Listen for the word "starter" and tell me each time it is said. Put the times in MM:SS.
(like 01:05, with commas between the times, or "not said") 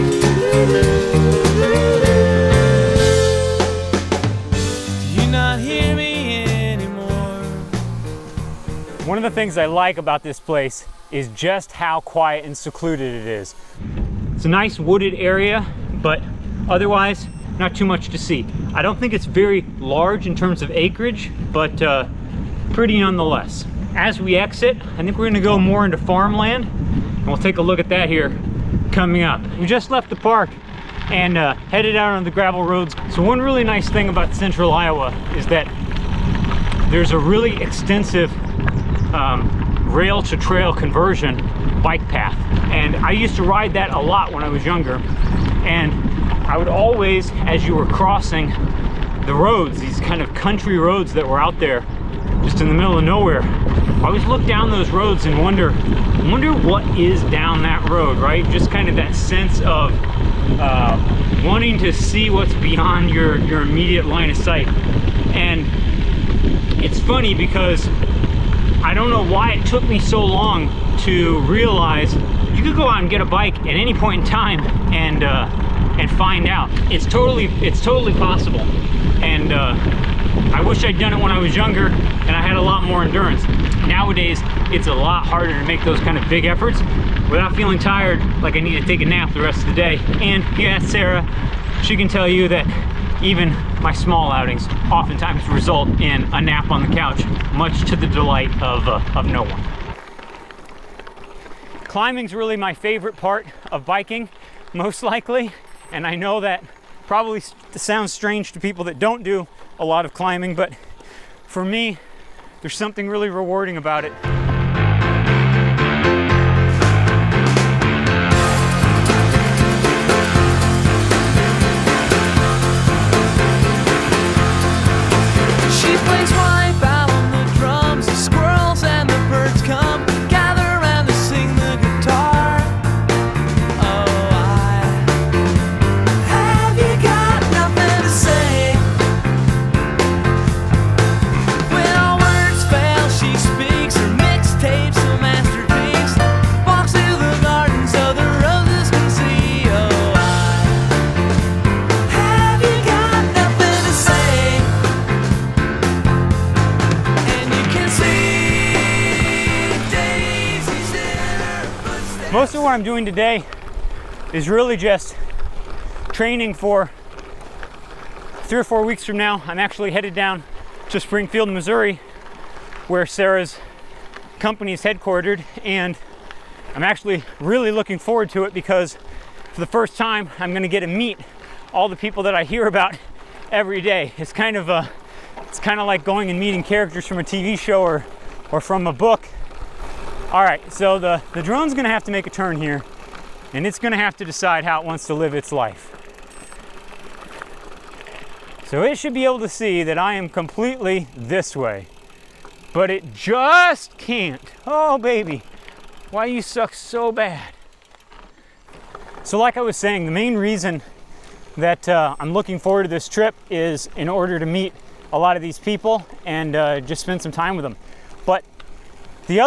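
not said.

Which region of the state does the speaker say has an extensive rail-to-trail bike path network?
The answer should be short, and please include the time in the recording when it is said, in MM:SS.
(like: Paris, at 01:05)
central Iowa, at 00:34.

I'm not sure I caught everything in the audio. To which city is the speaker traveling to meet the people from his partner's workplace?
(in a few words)
Springfield, Missouri.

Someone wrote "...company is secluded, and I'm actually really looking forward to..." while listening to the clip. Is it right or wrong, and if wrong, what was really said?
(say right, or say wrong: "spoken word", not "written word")
wrong: "headquartered", not "secluded".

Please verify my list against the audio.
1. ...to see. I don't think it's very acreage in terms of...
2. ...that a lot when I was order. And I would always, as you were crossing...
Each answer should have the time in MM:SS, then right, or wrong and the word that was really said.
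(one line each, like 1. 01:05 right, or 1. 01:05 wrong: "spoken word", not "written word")
1. 00:18 wrong: "large", not "acreage"
2. 00:43 wrong: "younger", not "order".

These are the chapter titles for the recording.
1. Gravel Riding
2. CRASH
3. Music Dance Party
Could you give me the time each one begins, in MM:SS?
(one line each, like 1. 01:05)
1. 00:15
2. 02:38
3. 01:52.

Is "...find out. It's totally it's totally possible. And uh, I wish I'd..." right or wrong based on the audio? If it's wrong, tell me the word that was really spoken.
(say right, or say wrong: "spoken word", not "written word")
right.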